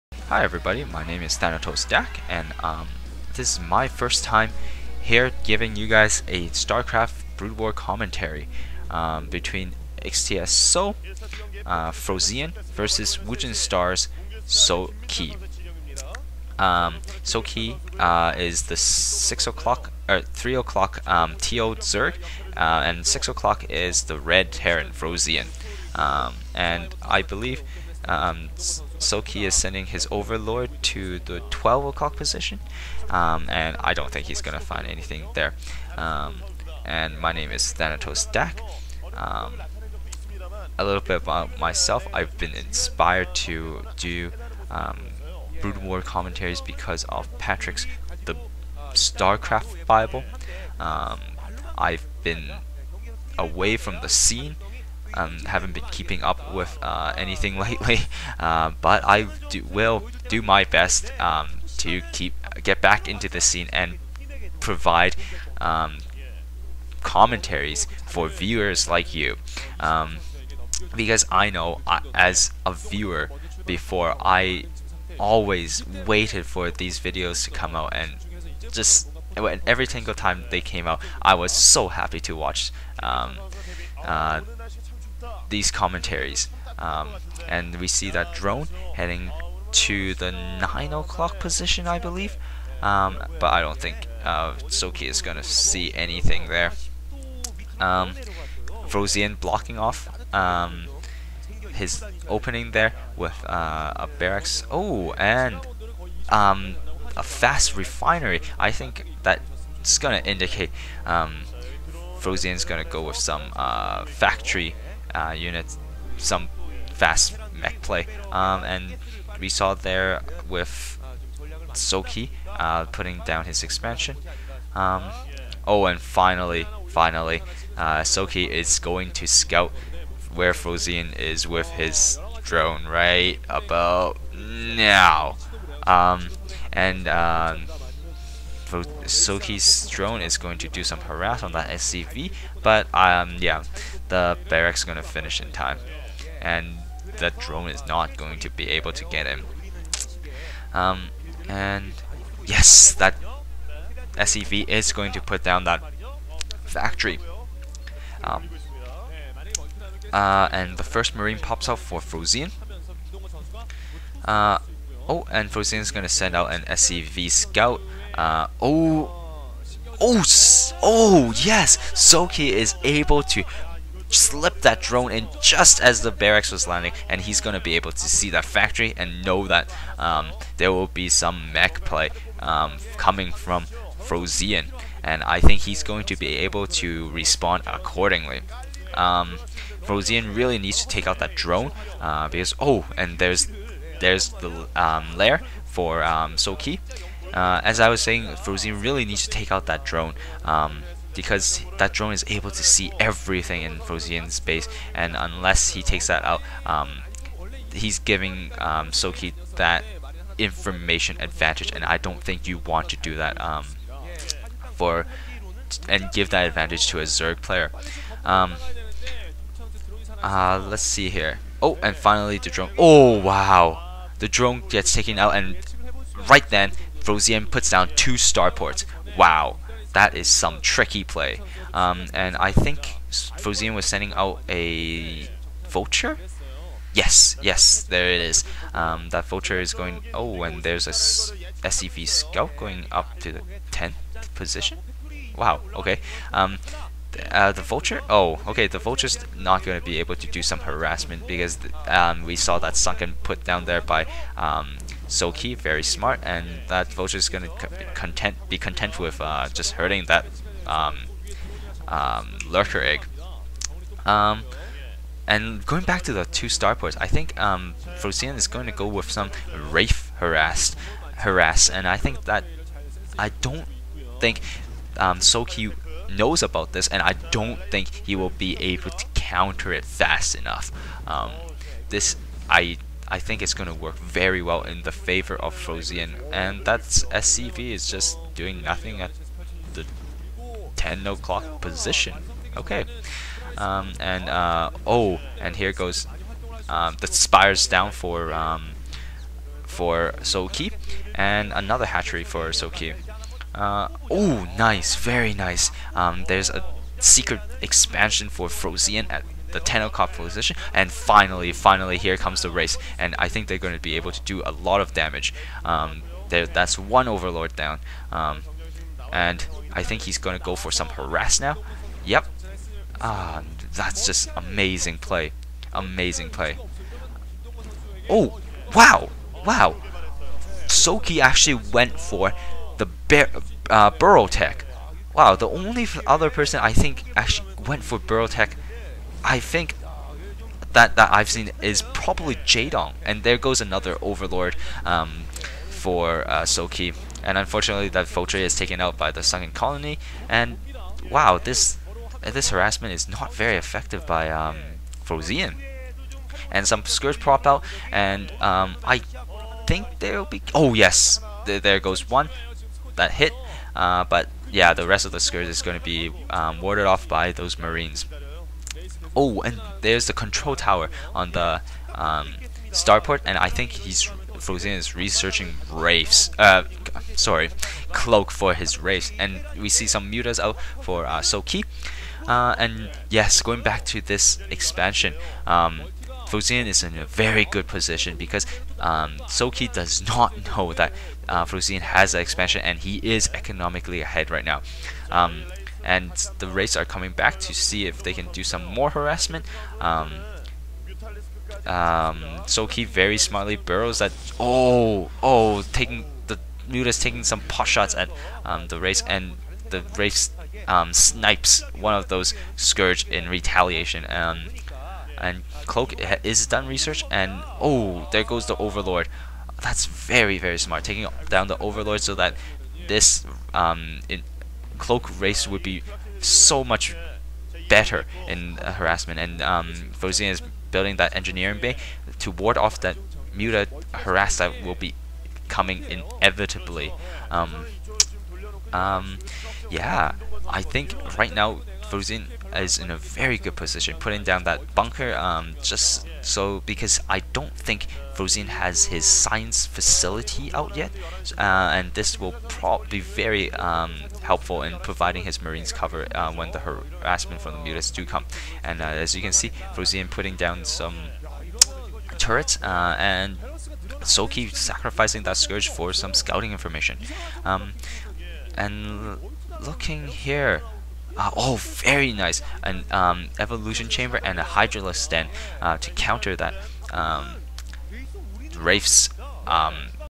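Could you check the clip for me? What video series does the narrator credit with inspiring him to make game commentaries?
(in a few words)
Patrick's The StarCraft Bible.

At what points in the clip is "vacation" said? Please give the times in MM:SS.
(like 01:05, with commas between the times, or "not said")
not said.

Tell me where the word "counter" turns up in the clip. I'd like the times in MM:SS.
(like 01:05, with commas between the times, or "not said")
04:39, 07:55.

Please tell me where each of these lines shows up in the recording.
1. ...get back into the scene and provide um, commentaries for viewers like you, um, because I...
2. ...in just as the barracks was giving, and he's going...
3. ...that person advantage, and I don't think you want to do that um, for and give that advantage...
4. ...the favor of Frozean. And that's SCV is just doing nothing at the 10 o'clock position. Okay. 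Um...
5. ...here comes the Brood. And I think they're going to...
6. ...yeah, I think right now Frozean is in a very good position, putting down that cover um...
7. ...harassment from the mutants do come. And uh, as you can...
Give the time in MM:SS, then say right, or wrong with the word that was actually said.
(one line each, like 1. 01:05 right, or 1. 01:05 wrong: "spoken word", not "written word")
1. 01:02 right
2. 02:55 wrong: "landing", not "giving"
3. 03:29 wrong: "information", not "person"
4. 04:44 right
5. 05:11 wrong: "Wraiths", not "Brood"
6. 07:19 wrong: "bunker", not "cover"
7. 07:36 right.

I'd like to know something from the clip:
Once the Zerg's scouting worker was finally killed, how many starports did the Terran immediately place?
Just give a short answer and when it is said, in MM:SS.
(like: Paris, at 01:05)
2, at 03:47.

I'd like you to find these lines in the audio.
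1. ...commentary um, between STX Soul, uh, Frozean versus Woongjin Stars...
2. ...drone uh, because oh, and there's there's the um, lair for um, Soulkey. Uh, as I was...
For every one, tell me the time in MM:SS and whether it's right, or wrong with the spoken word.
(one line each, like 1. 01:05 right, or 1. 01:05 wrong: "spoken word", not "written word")
1. 00:07 right
2. 03:11 right.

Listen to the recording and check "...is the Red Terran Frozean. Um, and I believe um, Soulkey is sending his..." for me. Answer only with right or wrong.
right.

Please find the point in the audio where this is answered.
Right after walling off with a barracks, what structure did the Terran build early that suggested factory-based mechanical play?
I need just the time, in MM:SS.
01:47.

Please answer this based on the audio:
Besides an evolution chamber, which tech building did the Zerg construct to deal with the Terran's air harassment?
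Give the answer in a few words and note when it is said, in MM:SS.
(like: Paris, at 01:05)
Hydralisk den, at 07:54.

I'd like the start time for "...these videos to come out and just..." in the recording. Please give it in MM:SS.
01:16.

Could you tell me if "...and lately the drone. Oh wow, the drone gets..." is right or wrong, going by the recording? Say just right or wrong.
wrong.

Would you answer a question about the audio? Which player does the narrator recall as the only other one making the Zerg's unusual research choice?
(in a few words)
Jaedong.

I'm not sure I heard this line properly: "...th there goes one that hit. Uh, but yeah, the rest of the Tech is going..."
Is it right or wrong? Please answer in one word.
wrong.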